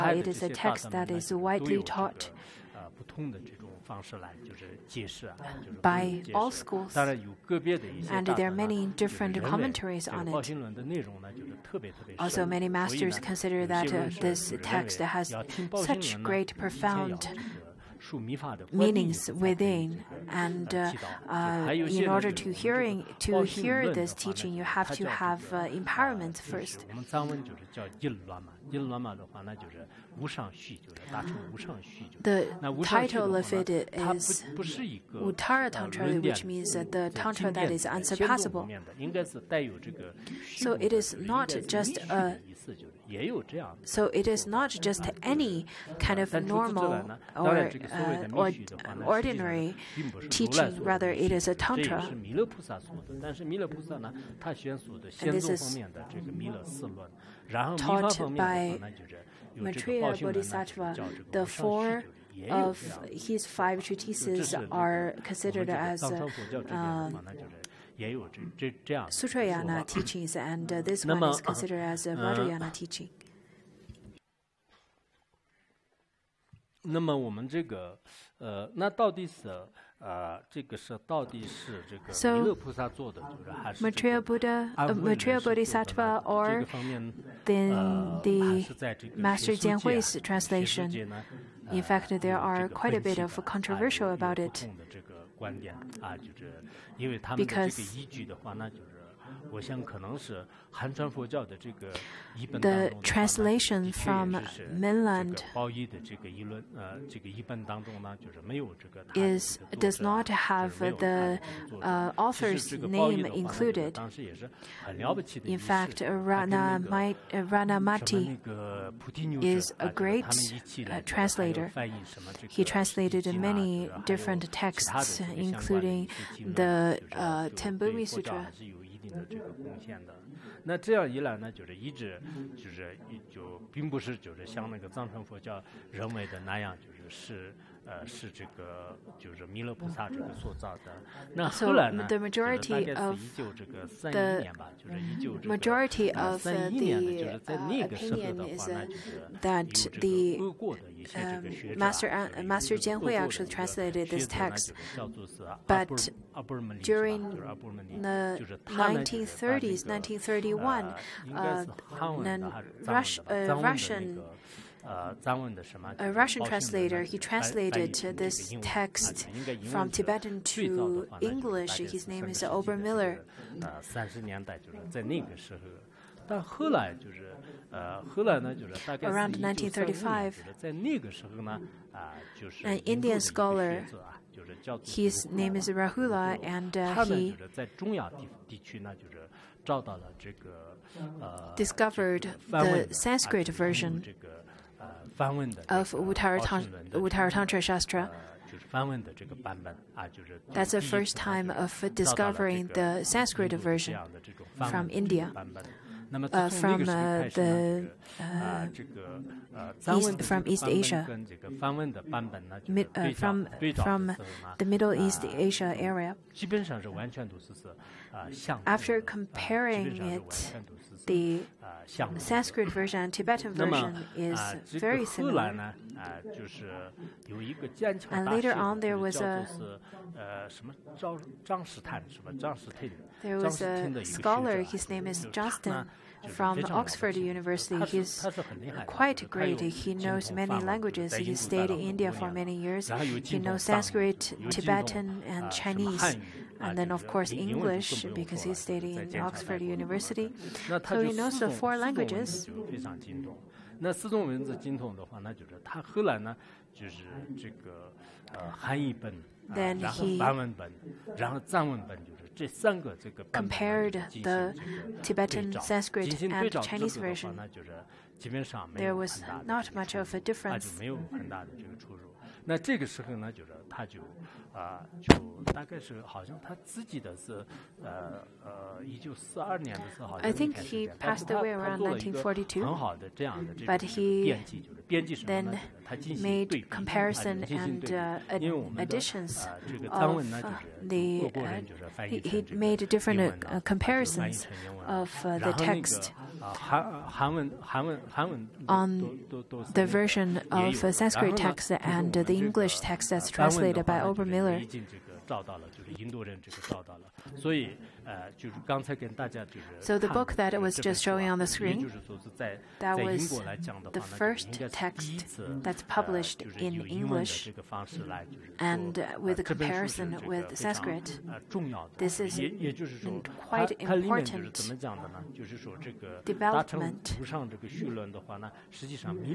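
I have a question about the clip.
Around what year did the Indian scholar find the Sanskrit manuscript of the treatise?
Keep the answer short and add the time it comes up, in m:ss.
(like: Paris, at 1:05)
1935, at 2:59.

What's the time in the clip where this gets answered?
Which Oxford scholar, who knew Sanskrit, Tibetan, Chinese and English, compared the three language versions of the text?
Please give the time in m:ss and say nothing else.
3:55.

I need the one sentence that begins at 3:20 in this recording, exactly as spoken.
That's the first time of discovering the Sanskrit version from India.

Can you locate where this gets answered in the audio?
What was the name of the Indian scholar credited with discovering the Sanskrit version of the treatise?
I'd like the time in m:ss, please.
3:05.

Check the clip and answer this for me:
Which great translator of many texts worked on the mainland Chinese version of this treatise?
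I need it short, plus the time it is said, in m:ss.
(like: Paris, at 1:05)
Ratnamati, at 1:57.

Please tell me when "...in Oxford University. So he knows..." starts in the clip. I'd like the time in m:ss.
4:08.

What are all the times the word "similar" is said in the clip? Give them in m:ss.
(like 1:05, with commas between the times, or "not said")
3:45.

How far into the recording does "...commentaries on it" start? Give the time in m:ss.
0:09.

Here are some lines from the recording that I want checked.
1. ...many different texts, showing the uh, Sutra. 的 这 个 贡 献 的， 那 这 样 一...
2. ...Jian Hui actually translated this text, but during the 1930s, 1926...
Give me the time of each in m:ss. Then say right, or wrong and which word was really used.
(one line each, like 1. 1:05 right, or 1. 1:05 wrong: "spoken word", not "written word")
1. 2:03 wrong: "including", not "showing"
2. 2:32 wrong: "1931", not "1926".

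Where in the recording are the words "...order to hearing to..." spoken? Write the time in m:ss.
0:22.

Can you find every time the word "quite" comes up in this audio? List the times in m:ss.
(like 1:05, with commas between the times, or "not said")
1:32, 3:58, 5:23.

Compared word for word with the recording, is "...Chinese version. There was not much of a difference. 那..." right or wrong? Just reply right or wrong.
right.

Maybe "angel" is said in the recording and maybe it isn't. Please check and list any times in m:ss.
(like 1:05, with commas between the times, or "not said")
not said.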